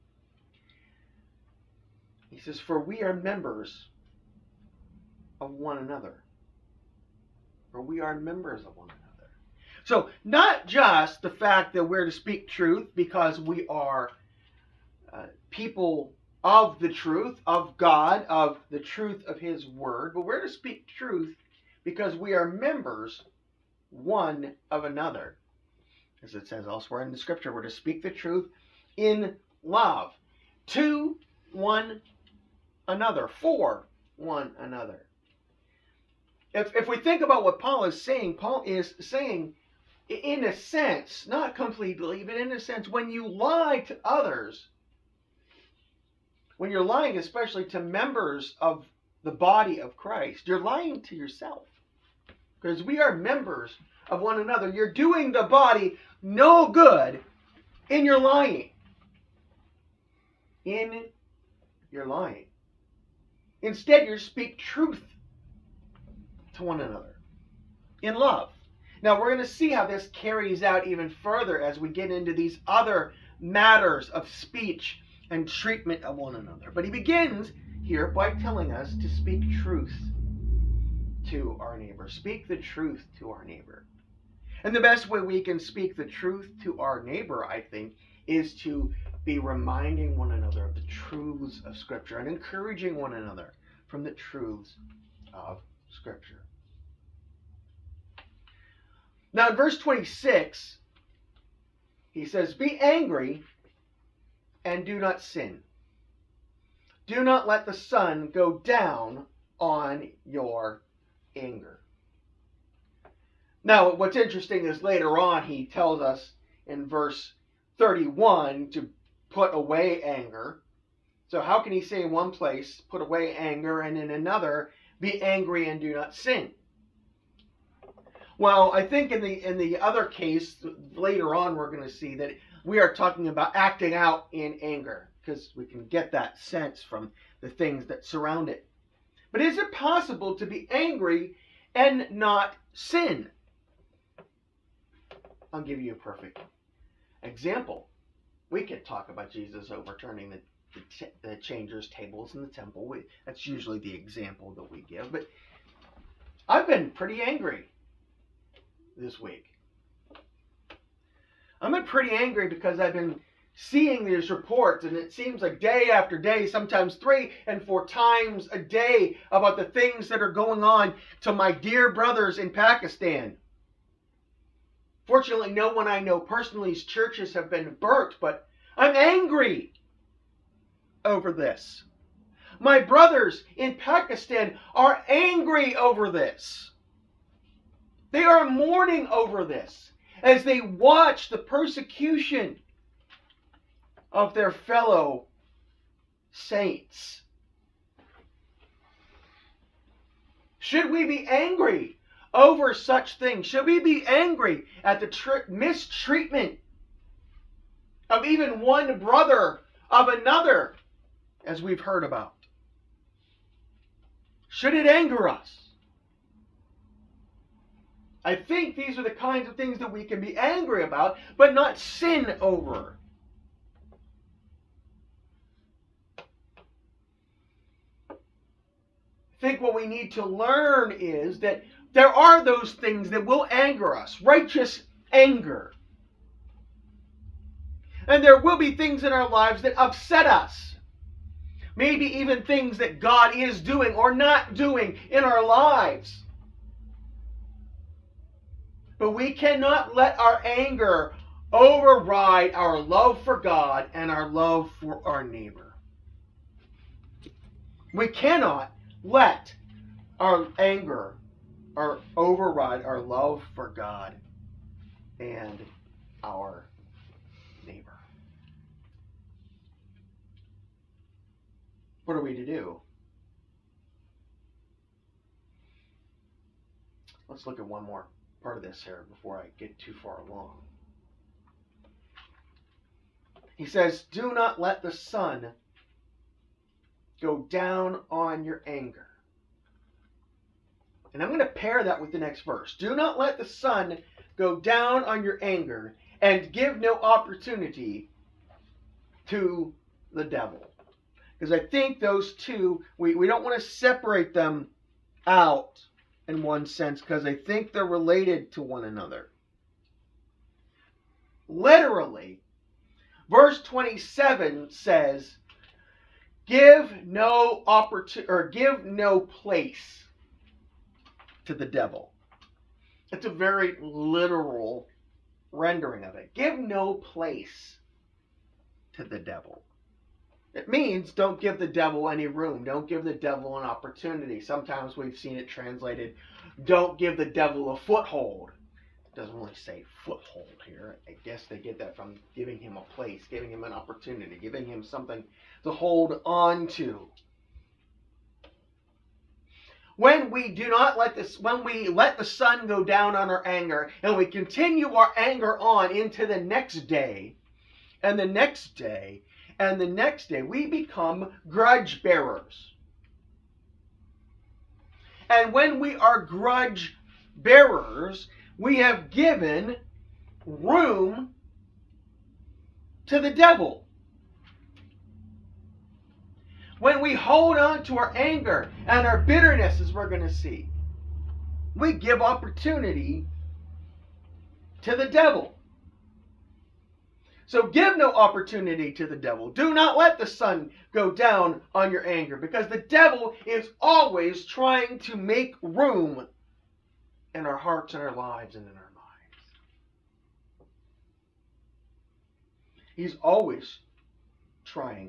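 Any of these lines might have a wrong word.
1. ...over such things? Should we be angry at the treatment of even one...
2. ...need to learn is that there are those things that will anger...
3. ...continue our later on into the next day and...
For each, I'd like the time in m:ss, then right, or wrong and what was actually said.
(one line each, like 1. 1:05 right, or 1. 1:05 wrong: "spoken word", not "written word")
1. 3:22 wrong: "mistreatment", not "treatment"
2. 3:49 right
3. 5:54 wrong: "anger", not "later".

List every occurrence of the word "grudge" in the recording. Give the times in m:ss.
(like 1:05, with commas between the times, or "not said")
6:01, 6:06.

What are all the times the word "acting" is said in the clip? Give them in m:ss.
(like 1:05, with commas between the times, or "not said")
2:13.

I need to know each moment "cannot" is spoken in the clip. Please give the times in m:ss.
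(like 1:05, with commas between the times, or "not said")
4:09, 4:18.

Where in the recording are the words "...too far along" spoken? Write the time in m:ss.
4:39.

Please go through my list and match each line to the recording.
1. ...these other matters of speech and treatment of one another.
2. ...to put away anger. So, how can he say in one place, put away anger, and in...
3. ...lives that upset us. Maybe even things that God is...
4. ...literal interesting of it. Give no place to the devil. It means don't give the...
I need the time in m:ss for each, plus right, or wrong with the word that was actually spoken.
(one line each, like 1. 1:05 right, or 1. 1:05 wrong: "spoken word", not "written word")
1. 1:12 right
2. 1:58 right
3. 3:59 right
4. 5:23 wrong: "rendering", not "interesting".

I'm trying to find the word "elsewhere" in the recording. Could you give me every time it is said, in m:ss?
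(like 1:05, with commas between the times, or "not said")
0:26.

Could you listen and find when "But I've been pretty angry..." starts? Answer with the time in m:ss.
2:35.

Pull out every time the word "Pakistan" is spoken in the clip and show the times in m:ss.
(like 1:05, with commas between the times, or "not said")
2:52, 3:03.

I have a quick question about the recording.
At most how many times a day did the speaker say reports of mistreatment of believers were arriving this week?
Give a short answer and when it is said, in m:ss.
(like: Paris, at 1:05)
4, at 2:47.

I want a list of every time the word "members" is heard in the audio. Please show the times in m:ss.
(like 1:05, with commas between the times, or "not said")
0:03, 0:08, 0:22, 0:47, 0:53.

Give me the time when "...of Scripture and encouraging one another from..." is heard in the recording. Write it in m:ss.
1:31.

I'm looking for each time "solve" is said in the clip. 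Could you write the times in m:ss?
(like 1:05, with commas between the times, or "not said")
not said.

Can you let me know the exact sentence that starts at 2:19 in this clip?
But is it possible to be angry and not sin?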